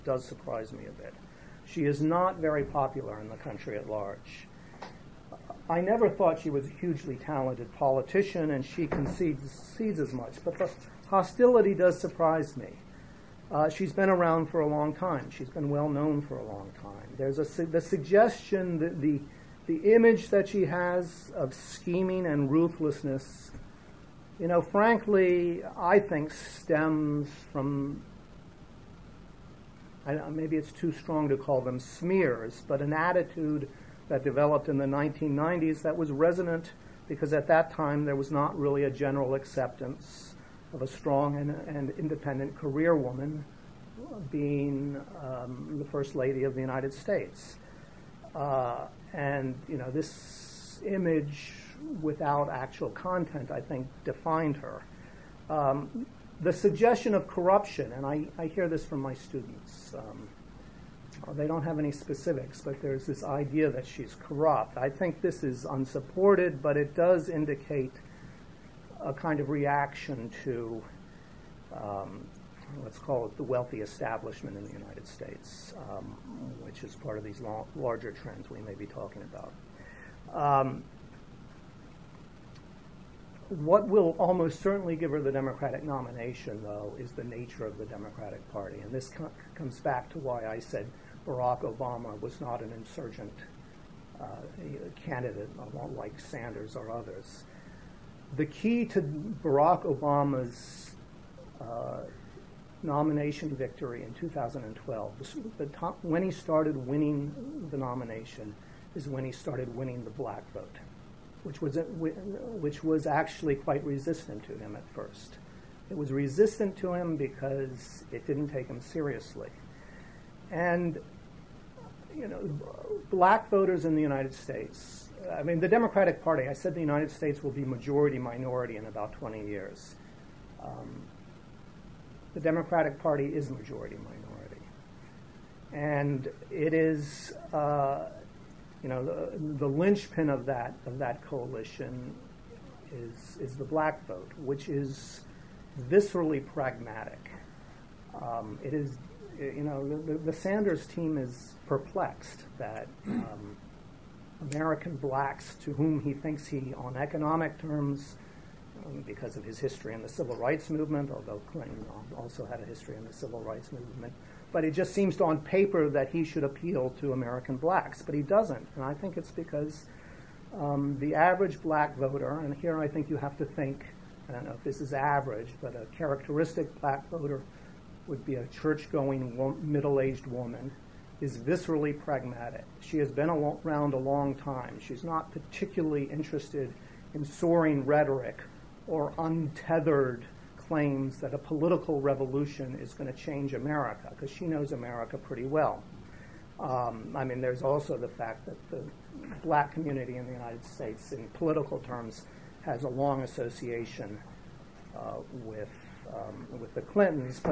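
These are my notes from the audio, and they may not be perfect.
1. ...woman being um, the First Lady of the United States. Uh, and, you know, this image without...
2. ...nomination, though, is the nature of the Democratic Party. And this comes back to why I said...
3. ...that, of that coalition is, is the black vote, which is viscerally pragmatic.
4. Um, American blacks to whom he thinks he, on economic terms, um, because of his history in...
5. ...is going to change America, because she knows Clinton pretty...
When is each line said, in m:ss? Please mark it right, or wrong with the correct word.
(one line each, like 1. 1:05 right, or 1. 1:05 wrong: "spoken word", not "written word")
1. 0:42 right
2. 1:25 right
3. 2:20 right
4. 2:33 right
5. 3:12 wrong: "America", not "Clinton".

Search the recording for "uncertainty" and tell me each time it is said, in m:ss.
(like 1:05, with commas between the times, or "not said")
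not said.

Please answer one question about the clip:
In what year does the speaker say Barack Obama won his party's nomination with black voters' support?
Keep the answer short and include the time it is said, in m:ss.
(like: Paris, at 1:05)
2012, at 1:44.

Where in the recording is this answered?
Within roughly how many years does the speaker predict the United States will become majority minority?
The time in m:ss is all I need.
2:09.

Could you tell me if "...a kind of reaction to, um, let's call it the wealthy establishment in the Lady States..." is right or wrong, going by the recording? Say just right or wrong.
wrong.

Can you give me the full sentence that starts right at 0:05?
I never thought she was a hugely talented politician, and she concedes, concedes as much, but the hostility does surprise me.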